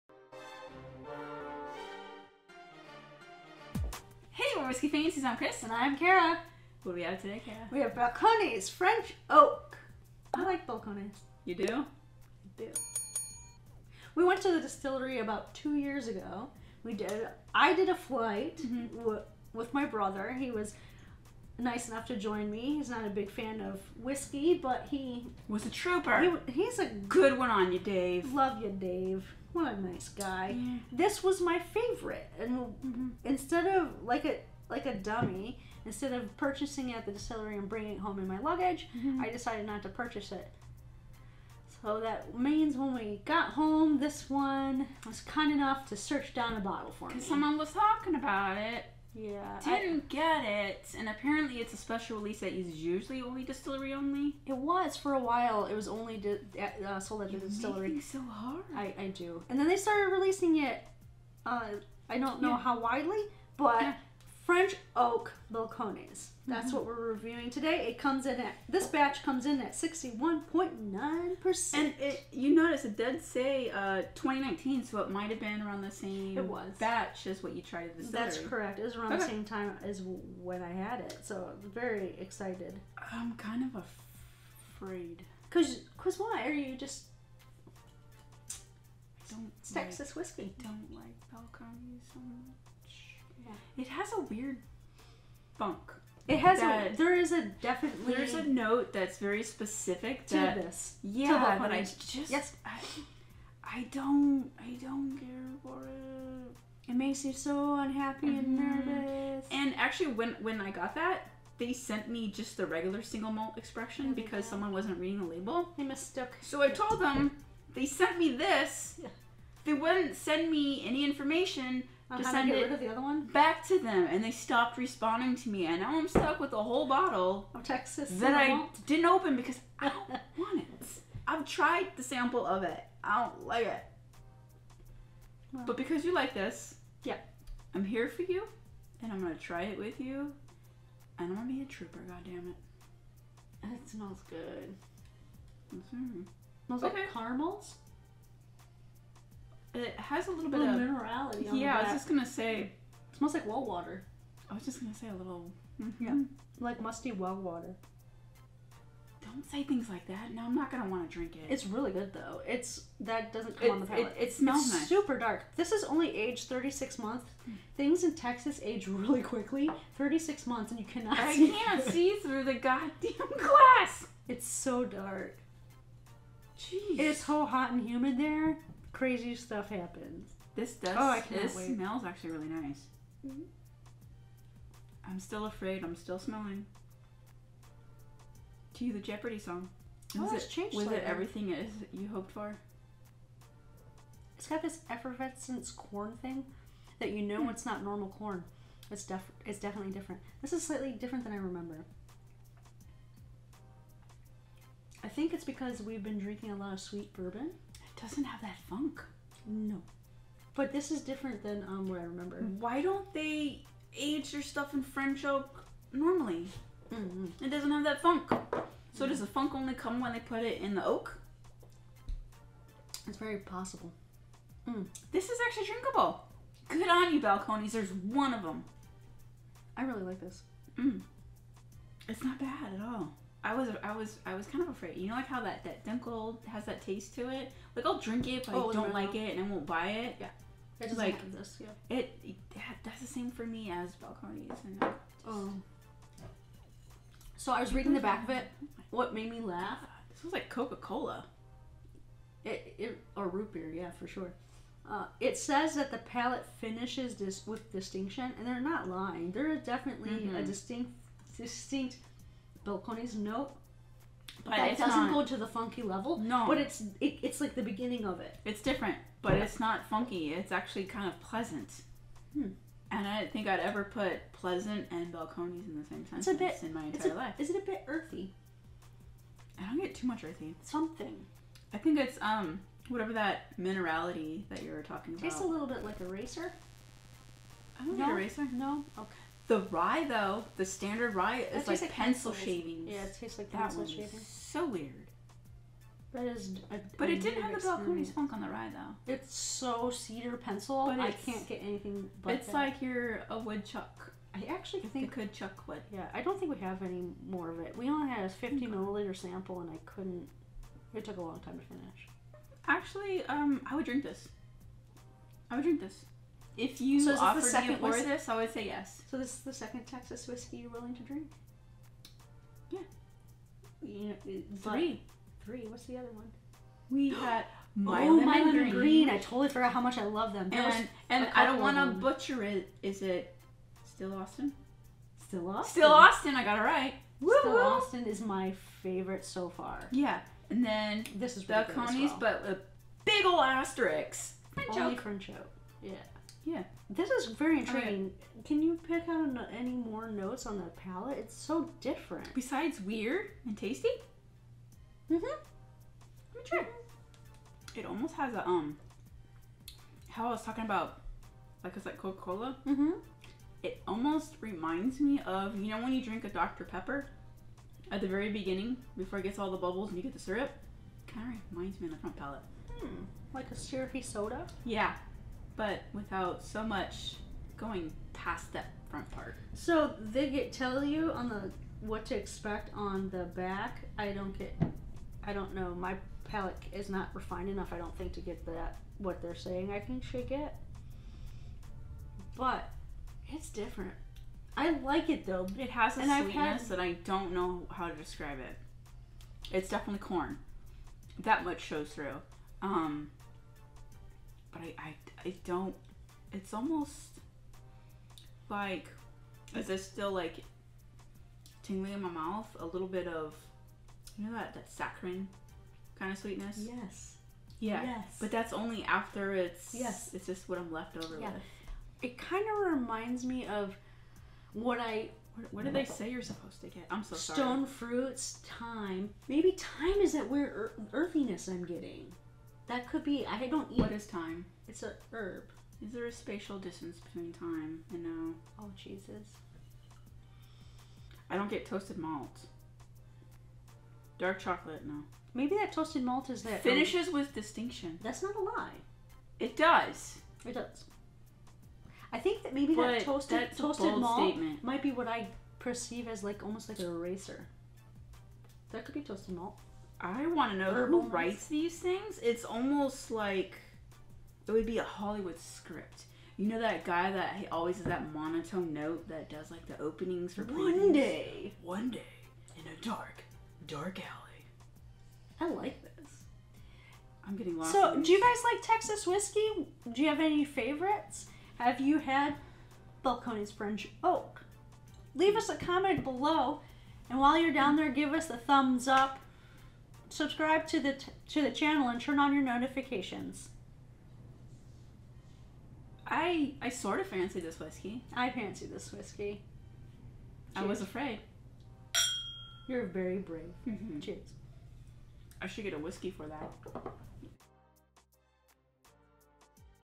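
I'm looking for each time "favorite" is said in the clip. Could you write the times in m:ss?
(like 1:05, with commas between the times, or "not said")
0:31, 5:38, 8:00.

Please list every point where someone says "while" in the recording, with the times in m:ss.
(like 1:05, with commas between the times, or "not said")
0:55, 8:07.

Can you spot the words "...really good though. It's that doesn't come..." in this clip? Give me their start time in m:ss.
2:41.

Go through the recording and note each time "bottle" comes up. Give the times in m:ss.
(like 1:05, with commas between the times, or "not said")
0:46, 2:06.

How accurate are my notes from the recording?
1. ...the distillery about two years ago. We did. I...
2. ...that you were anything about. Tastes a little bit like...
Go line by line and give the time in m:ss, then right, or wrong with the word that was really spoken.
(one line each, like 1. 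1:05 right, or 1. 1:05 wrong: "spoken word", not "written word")
1. 0:14 right
2. 4:44 wrong: "talking", not "anything".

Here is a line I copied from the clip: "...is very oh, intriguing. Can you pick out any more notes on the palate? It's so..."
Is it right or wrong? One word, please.
right.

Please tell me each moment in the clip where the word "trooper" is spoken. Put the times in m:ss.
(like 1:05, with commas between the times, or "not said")
0:25, 2:21.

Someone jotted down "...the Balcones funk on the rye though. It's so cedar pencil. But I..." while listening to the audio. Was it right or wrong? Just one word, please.
right.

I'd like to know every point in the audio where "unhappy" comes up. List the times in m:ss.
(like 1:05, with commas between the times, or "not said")
1:47.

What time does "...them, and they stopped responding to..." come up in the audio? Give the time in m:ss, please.
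2:03.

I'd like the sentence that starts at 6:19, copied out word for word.
So they get tell you on the what to expect on the back.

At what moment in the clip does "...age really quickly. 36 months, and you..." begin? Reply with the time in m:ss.
2:48.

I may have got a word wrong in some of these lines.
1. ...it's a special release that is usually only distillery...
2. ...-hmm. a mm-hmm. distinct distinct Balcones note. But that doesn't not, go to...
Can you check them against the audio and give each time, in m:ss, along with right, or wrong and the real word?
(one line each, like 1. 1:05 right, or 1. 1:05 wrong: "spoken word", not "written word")
1. 0:51 right
2. 4:20 right.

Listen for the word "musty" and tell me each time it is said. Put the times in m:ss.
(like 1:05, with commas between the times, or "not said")
2:36.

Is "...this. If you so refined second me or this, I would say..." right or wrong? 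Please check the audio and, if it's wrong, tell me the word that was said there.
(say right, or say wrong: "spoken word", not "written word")
wrong: "offered", not "refined".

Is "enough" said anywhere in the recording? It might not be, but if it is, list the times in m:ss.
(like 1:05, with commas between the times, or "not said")
0:21, 0:45, 6:27.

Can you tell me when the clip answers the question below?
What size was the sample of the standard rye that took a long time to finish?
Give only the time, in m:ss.
5:08.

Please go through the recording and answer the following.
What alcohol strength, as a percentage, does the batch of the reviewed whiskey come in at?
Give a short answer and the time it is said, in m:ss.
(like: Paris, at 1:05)
61.9%, at 1:09.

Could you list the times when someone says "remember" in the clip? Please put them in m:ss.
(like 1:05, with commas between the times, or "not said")
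3:21, 3:32.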